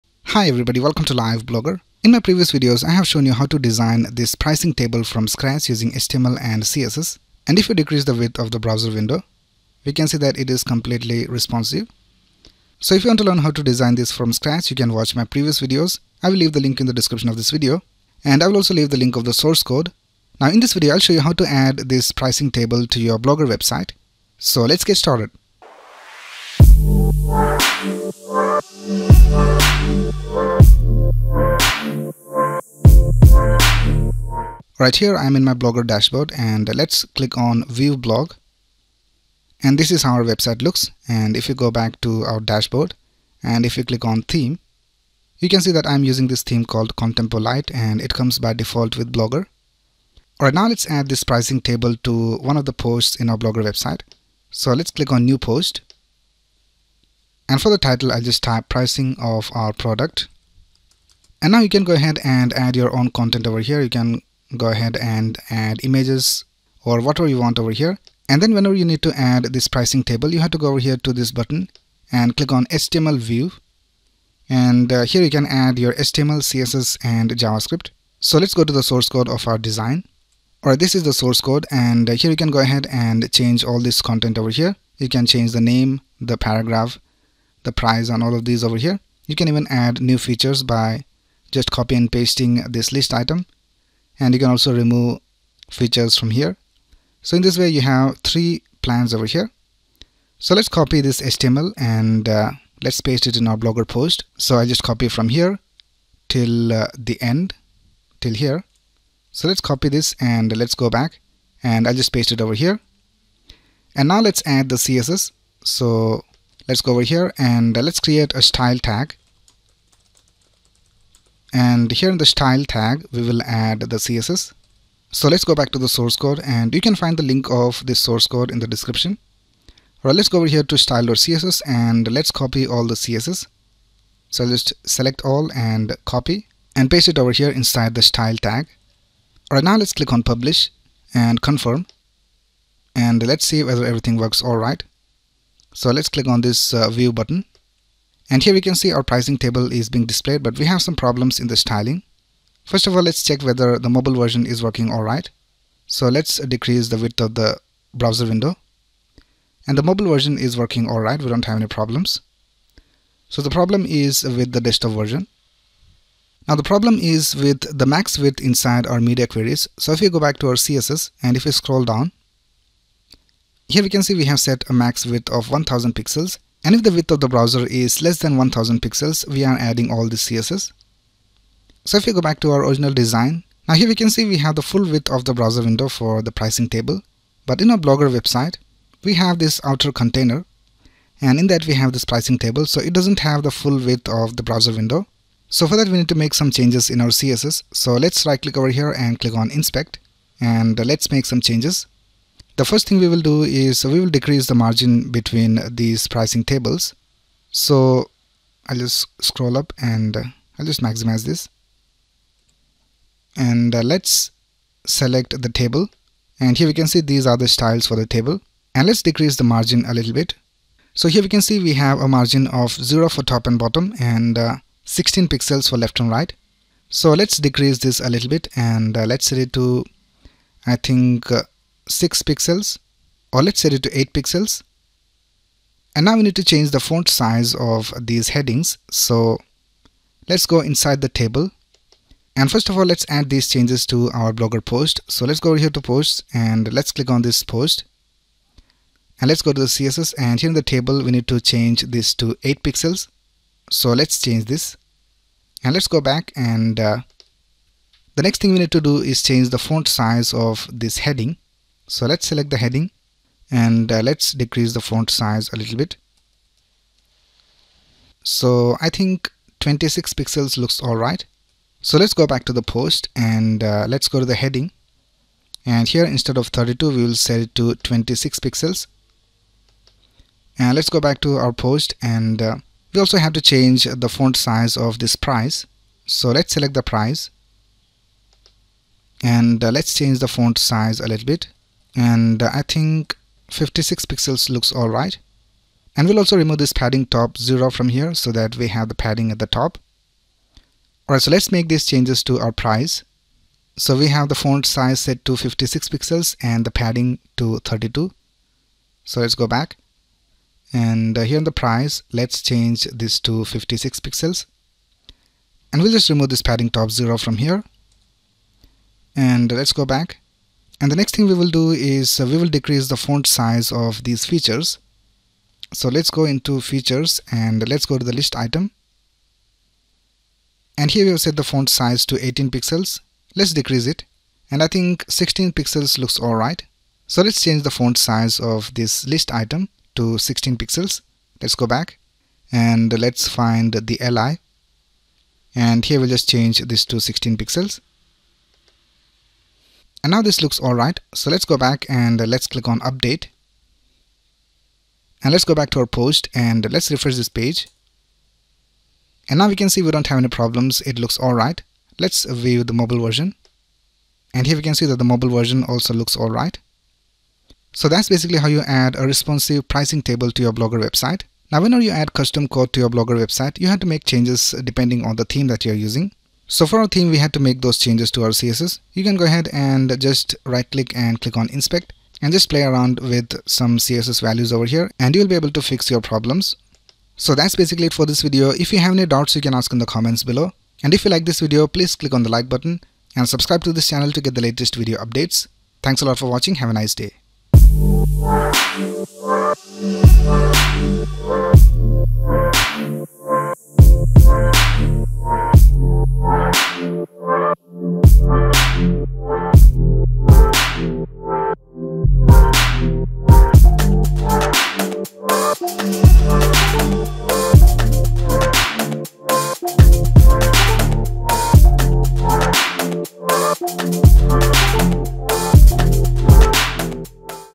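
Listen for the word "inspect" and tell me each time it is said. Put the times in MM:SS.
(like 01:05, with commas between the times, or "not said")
03:19, 06:21.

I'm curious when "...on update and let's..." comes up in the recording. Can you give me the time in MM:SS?
05:52.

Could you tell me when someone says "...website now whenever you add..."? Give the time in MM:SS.
06:10.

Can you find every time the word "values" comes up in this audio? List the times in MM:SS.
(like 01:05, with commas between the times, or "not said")
06:24.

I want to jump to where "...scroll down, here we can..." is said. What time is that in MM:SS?
02:51.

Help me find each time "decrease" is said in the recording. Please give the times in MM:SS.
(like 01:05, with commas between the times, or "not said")
00:07, 02:36, 03:24, 03:39, 03:47, 04:24, 05:22, 05:33.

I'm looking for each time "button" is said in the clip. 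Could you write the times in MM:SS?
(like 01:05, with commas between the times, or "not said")
01:11, 02:27, 06:32.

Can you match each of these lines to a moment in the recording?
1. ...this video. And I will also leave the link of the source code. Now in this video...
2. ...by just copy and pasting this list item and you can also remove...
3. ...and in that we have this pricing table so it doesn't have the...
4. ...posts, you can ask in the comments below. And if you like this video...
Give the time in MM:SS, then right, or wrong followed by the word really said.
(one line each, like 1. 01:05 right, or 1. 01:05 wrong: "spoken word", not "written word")
1. 00:17 right
2. 01:30 right
3. 03:11 right
4. 06:29 wrong: "doubts", not "posts".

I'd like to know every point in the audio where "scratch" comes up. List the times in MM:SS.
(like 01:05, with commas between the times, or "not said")
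00:05, 00:14.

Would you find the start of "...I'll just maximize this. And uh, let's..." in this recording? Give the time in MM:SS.
03:30.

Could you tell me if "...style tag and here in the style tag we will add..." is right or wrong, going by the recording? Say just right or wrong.
right.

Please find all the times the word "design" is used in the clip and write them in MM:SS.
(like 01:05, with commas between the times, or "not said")
00:03, 00:13, 01:19, 03:02.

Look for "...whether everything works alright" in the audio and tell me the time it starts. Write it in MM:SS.
02:23.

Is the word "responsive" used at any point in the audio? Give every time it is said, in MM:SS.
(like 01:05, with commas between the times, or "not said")
00:11, 06:09.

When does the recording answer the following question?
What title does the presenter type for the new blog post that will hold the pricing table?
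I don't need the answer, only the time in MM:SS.
00:58.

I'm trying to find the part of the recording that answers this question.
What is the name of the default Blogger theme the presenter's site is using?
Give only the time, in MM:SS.
00:47.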